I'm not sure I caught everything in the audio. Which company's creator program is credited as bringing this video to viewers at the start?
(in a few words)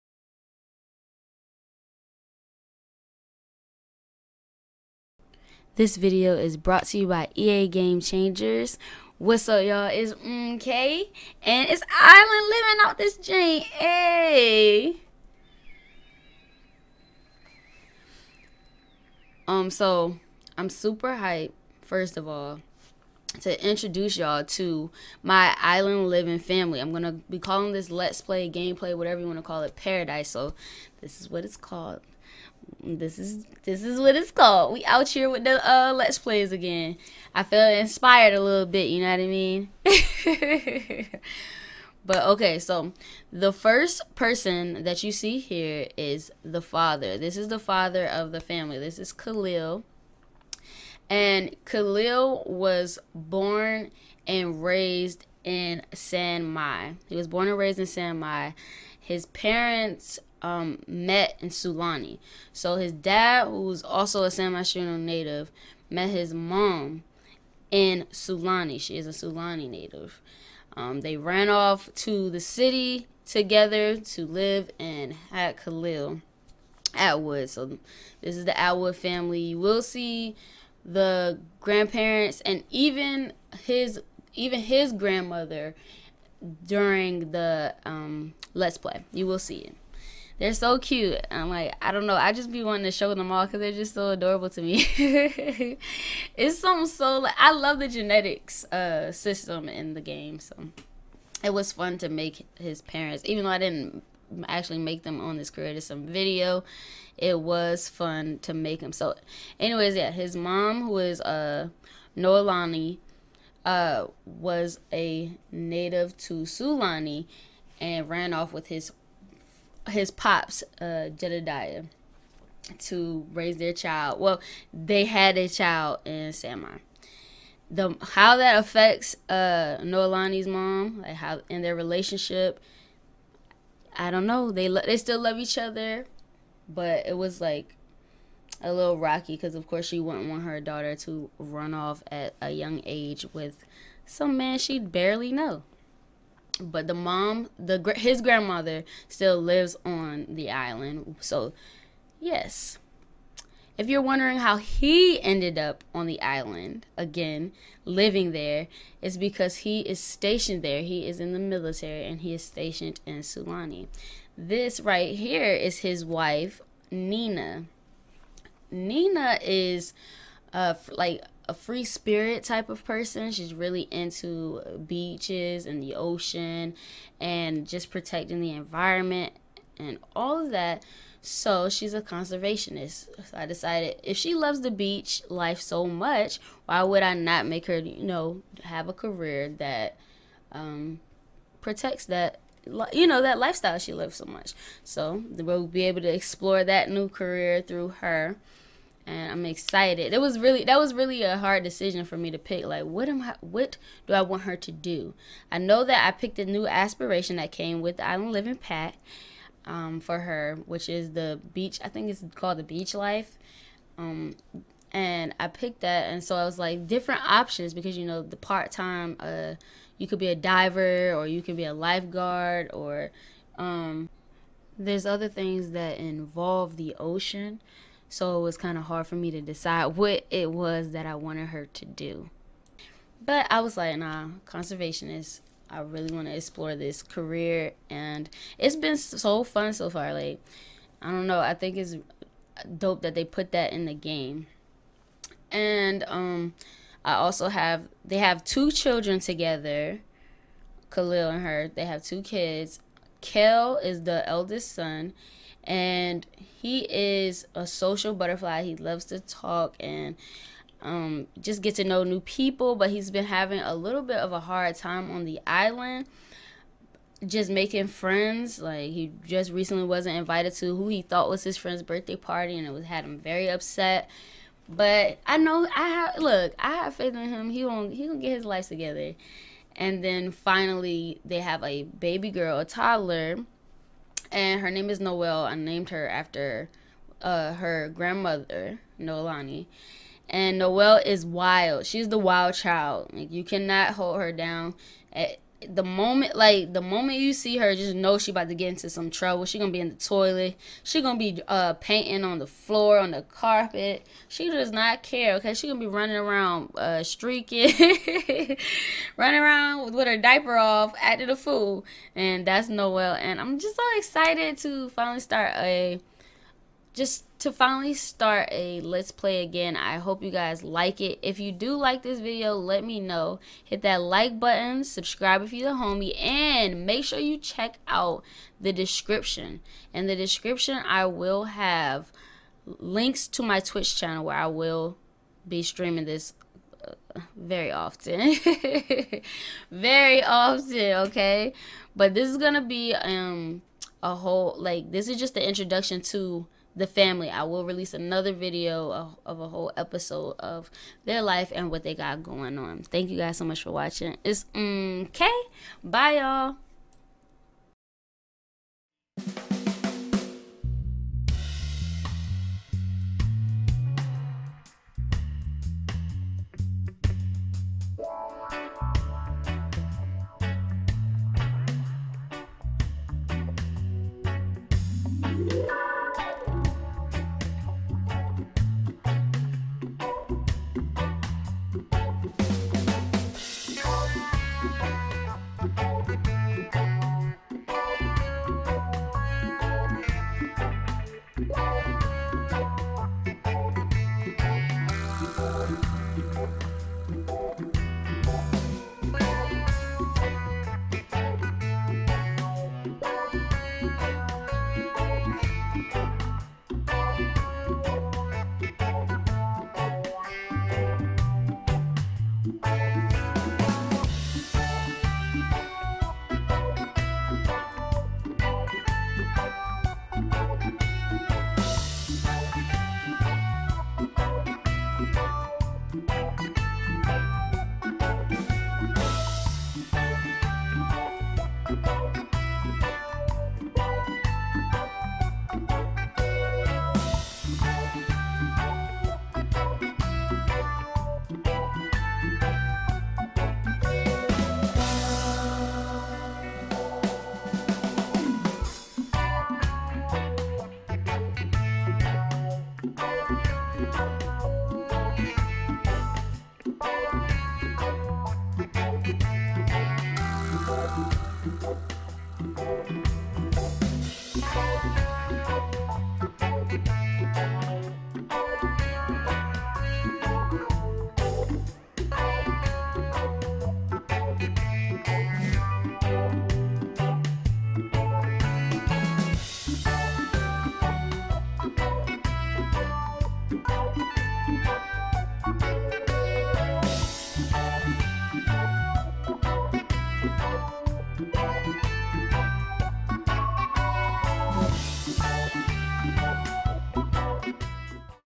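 EA Game Changers.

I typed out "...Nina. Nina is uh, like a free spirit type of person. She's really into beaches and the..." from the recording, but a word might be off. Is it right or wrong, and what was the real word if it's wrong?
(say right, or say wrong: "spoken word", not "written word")
right.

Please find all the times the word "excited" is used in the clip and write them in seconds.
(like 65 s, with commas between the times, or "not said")
199 s, 313 s.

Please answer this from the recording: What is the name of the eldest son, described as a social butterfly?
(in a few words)
Kel.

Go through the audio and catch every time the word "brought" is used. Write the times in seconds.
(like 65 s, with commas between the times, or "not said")
6 s.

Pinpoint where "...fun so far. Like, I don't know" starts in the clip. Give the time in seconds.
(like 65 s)
239 s.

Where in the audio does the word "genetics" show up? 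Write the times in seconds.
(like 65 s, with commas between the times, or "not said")
97 s.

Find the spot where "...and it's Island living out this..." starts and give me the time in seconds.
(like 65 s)
11 s.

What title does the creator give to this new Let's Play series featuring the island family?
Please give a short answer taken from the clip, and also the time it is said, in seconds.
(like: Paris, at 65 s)
Paradise, at 29 s.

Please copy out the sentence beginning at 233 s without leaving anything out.
But I was like, nah, conservationist.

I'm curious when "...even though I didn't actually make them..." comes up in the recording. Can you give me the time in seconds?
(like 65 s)
103 s.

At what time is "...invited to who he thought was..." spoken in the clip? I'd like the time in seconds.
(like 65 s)
270 s.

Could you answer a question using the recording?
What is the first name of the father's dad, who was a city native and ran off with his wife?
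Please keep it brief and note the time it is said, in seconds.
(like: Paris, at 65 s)
Jedediah, at 121 s.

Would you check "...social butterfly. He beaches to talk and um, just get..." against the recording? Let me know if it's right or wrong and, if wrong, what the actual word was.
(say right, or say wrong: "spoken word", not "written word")
wrong: "loves", not "beaches".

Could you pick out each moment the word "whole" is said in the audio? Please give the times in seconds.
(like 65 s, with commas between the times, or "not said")
344 s, 349 s.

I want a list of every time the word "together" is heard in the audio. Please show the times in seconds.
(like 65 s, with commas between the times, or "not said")
73 s, 249 s, 278 s.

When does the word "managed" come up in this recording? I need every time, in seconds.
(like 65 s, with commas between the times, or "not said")
not said.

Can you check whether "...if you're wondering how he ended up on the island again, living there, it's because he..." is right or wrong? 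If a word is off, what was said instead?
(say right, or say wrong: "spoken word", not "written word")
right.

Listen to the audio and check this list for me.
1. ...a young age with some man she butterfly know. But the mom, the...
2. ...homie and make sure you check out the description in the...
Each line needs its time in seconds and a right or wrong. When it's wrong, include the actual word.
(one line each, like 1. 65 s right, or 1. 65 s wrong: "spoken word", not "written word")
1. 142 s wrong: "barely", not "butterfly"
2. 325 s right.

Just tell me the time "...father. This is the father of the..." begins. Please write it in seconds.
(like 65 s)
46 s.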